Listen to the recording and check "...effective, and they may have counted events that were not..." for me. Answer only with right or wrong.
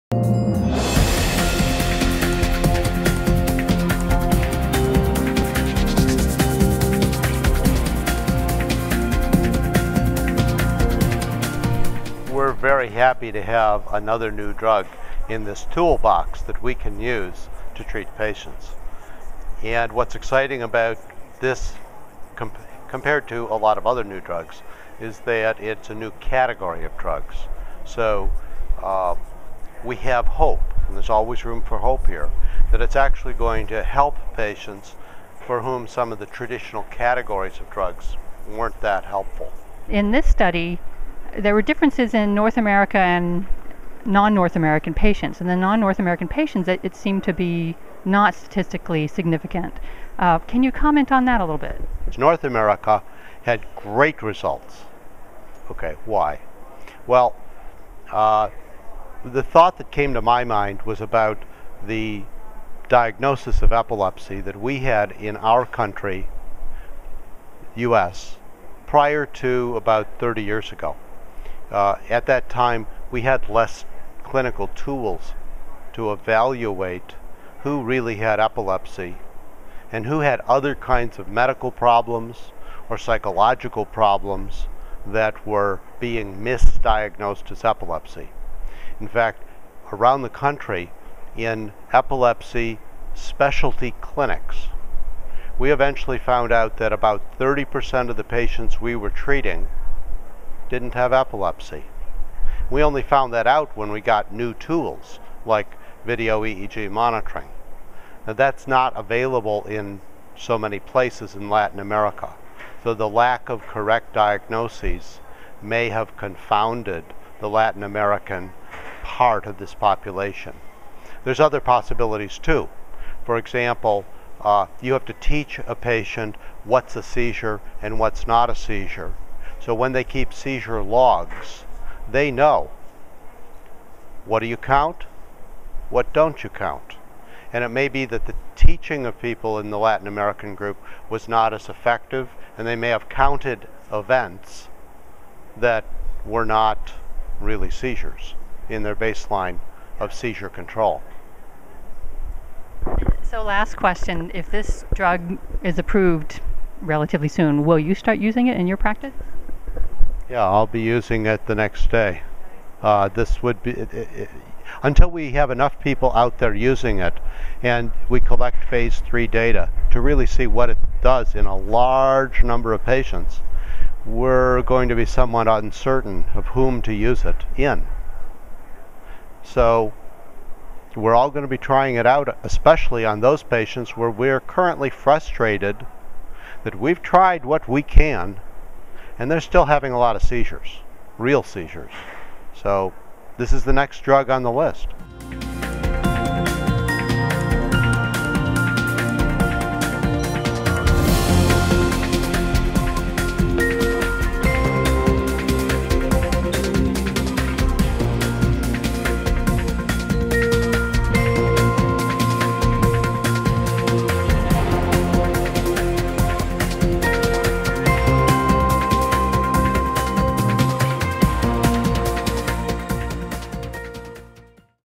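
right.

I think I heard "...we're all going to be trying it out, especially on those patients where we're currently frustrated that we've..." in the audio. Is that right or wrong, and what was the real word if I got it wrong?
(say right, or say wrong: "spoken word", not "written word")
right.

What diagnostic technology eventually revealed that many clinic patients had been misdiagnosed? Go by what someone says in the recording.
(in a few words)
video EEG monitoring.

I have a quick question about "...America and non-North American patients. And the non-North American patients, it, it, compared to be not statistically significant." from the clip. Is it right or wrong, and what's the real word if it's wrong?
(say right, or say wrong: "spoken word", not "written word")
wrong: "seemed", not "compared".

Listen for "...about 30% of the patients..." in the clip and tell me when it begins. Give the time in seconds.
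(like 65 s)
96 s.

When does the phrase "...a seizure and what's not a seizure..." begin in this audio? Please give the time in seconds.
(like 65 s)
126 s.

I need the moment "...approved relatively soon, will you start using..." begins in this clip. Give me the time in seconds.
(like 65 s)
155 s.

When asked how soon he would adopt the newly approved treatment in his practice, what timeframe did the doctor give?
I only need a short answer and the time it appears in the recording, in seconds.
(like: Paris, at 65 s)
the next day, at 161 s.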